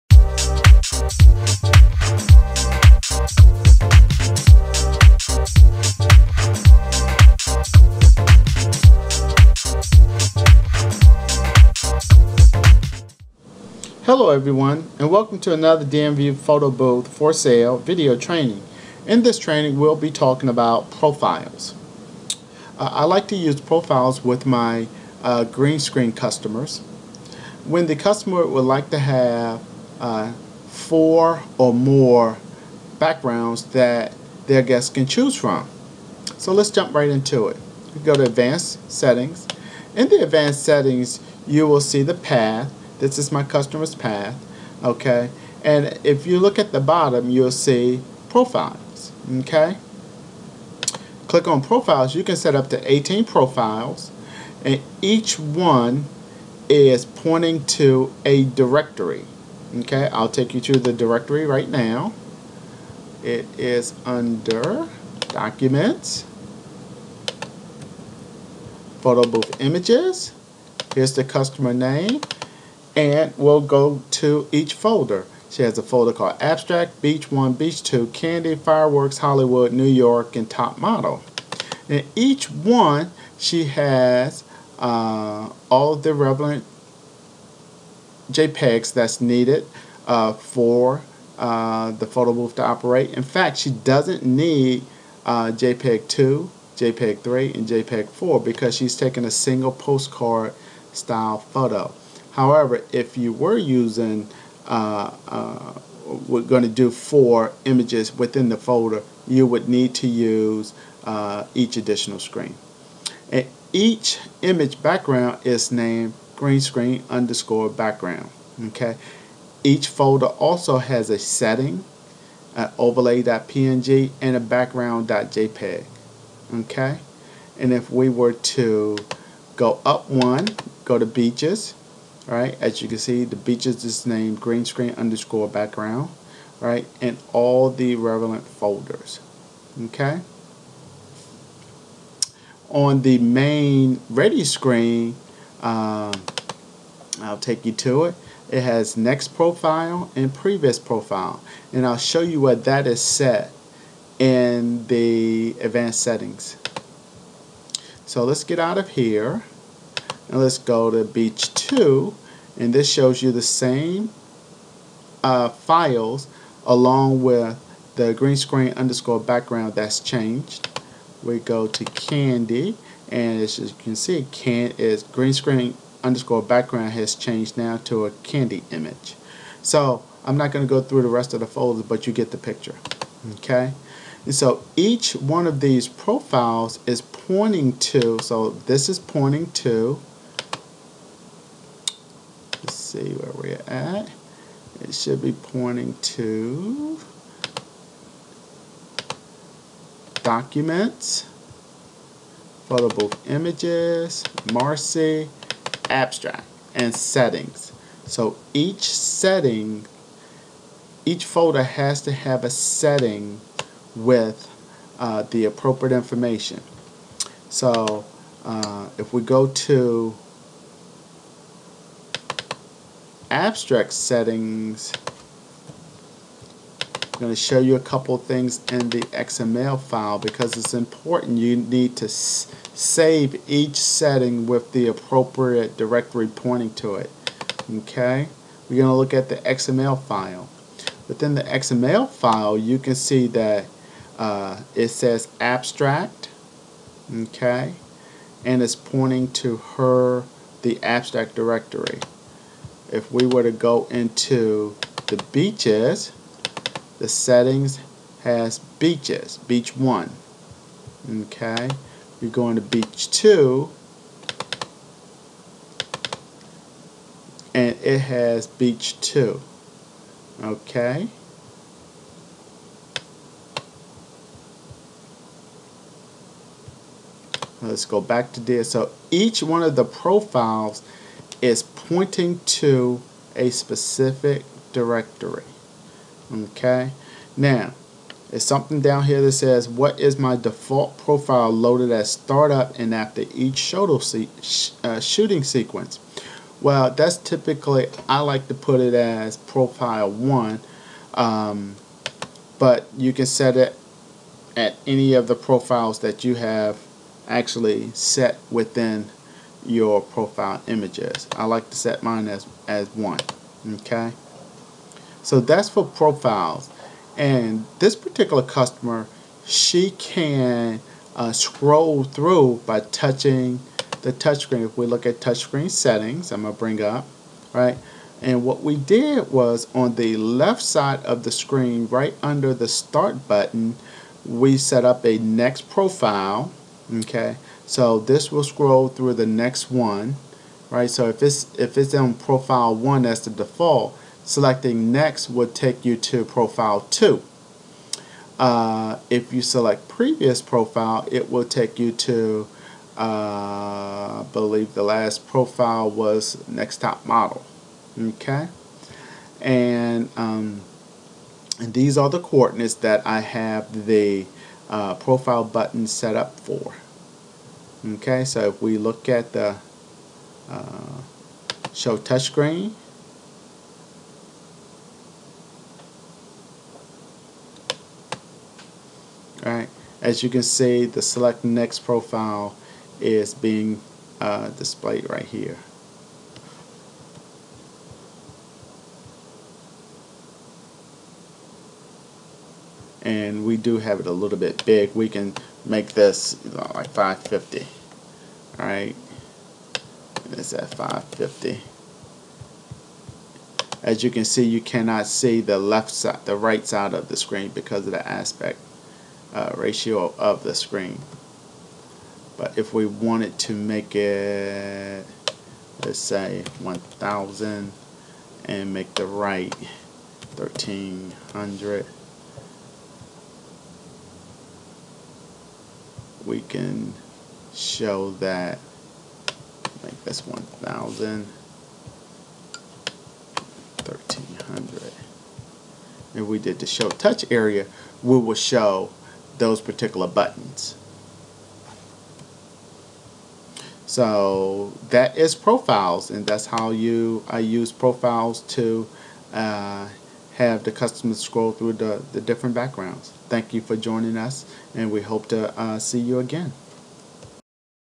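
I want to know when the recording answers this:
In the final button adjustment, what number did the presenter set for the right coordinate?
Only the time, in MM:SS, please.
06:58.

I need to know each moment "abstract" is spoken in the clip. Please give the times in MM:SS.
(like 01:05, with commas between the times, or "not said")
01:16, 03:25, 03:43, 04:05, 04:10.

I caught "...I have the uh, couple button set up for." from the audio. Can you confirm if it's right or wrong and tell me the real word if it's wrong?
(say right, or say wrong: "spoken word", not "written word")
wrong: "profile", not "couple".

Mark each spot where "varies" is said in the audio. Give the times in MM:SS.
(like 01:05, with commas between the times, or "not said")
not said.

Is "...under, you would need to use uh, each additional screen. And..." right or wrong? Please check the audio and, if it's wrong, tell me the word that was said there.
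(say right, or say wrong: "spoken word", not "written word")
wrong: "folder", not "under".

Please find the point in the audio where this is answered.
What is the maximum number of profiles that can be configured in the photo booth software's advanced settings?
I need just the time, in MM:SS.
00:52.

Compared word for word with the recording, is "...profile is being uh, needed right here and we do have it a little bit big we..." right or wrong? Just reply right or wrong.
wrong.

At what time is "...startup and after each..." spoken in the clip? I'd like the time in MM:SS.
04:52.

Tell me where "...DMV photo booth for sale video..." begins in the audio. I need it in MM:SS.
00:15.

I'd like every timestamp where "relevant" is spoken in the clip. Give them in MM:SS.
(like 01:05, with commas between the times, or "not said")
01:26, 02:17.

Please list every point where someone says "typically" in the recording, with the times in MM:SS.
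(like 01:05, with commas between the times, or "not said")
04:57.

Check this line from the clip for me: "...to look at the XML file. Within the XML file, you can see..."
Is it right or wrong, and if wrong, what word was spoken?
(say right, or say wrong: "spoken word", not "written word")
right.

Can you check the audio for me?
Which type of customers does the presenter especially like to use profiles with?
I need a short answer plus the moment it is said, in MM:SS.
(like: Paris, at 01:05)
green screen customers, at 00:25.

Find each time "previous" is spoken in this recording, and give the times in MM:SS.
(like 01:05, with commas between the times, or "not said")
02:30, 05:49.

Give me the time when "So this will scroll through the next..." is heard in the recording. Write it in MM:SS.
05:37.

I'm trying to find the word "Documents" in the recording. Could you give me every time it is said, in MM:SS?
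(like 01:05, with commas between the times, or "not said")
01:05, 03:20.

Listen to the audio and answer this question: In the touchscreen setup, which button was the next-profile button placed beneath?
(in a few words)
start button.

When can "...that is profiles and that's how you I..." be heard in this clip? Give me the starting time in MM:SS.
07:24.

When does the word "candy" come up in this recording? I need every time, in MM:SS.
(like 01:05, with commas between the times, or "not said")
01:18, 02:51, 02:58.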